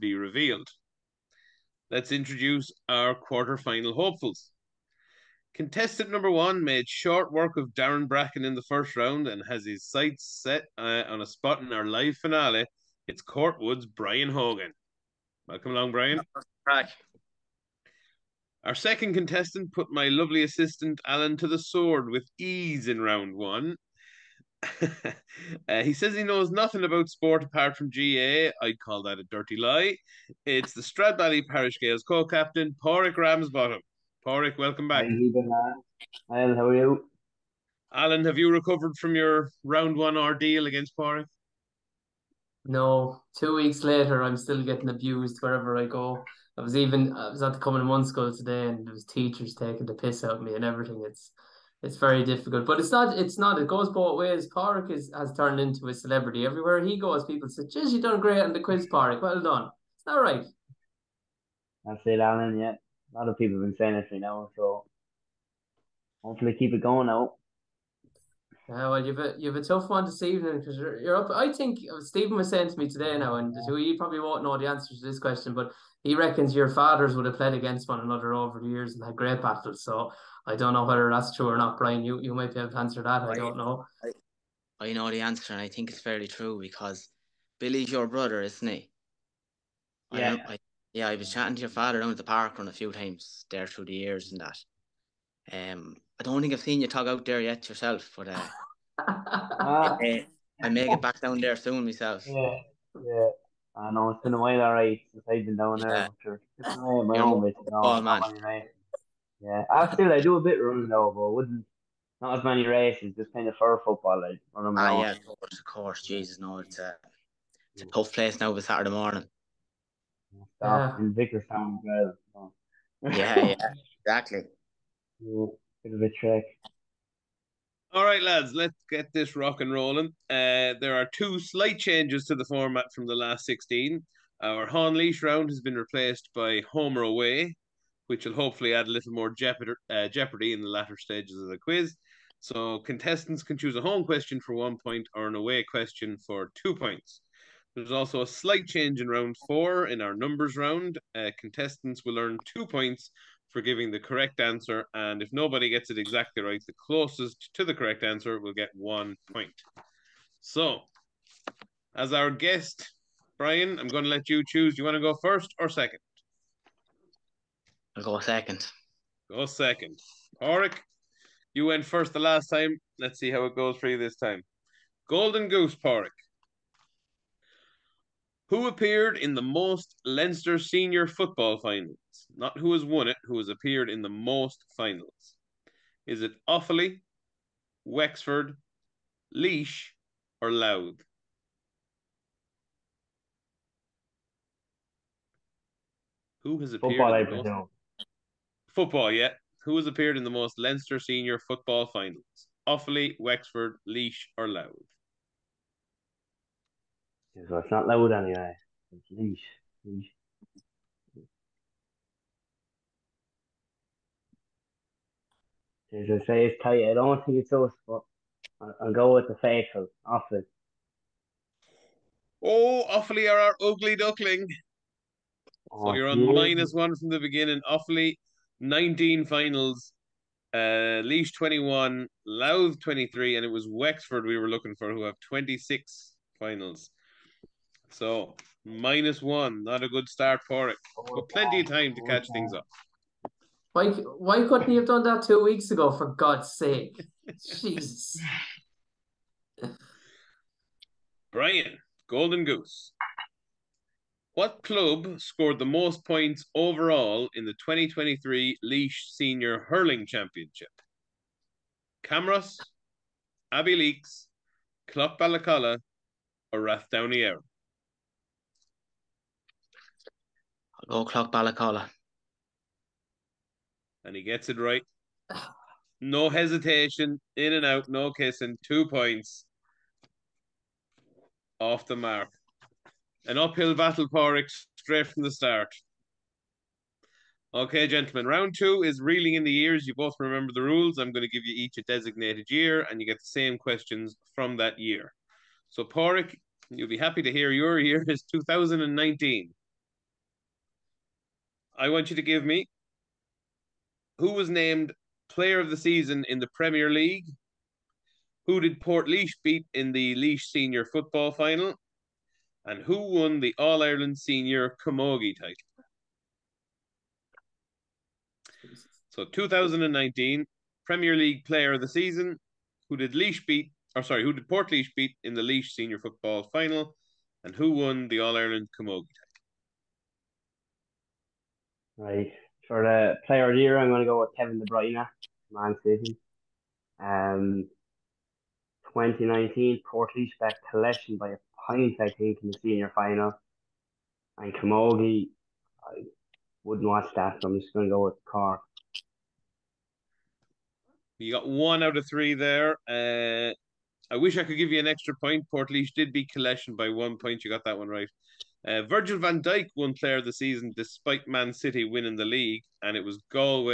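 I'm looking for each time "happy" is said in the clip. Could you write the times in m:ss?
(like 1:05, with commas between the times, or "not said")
4:56.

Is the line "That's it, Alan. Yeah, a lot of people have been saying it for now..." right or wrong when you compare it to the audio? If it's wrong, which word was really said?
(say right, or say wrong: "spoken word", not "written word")
right.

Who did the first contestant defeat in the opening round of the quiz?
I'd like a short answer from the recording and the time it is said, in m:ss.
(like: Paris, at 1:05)
Darren Bracken, at 0:07.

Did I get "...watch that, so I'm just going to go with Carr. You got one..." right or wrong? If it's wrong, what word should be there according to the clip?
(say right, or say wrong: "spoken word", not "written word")
right.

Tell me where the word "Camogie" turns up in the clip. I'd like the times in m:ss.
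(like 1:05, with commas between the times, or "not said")
5:14, 5:28, 5:44.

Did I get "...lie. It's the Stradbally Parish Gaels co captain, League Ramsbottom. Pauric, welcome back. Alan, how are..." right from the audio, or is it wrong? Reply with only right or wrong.
wrong.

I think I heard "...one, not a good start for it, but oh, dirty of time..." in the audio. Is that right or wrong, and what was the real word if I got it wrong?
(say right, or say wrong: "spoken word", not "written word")
wrong: "plenty", not "dirty".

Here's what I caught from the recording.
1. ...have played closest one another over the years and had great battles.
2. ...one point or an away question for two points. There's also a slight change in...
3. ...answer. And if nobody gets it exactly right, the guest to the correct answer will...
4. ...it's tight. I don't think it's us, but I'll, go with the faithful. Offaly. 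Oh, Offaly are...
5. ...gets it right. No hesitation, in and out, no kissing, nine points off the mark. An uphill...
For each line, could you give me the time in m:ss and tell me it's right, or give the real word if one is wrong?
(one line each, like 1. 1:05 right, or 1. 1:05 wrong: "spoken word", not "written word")
1. 1:17 wrong: "against", not "closest"
2. 2:24 right
3. 2:34 wrong: "closest", not "guest"
4. 3:36 right
5. 4:34 wrong: "two", not "nine".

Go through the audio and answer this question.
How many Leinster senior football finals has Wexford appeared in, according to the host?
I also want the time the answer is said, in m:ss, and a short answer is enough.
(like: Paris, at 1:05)
26, at 3:55.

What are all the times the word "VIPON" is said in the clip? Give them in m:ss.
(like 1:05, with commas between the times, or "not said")
not said.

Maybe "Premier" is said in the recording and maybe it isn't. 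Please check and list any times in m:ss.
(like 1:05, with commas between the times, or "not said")
5:06, 5:20.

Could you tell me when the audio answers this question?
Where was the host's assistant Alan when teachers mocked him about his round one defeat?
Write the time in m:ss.
0:47.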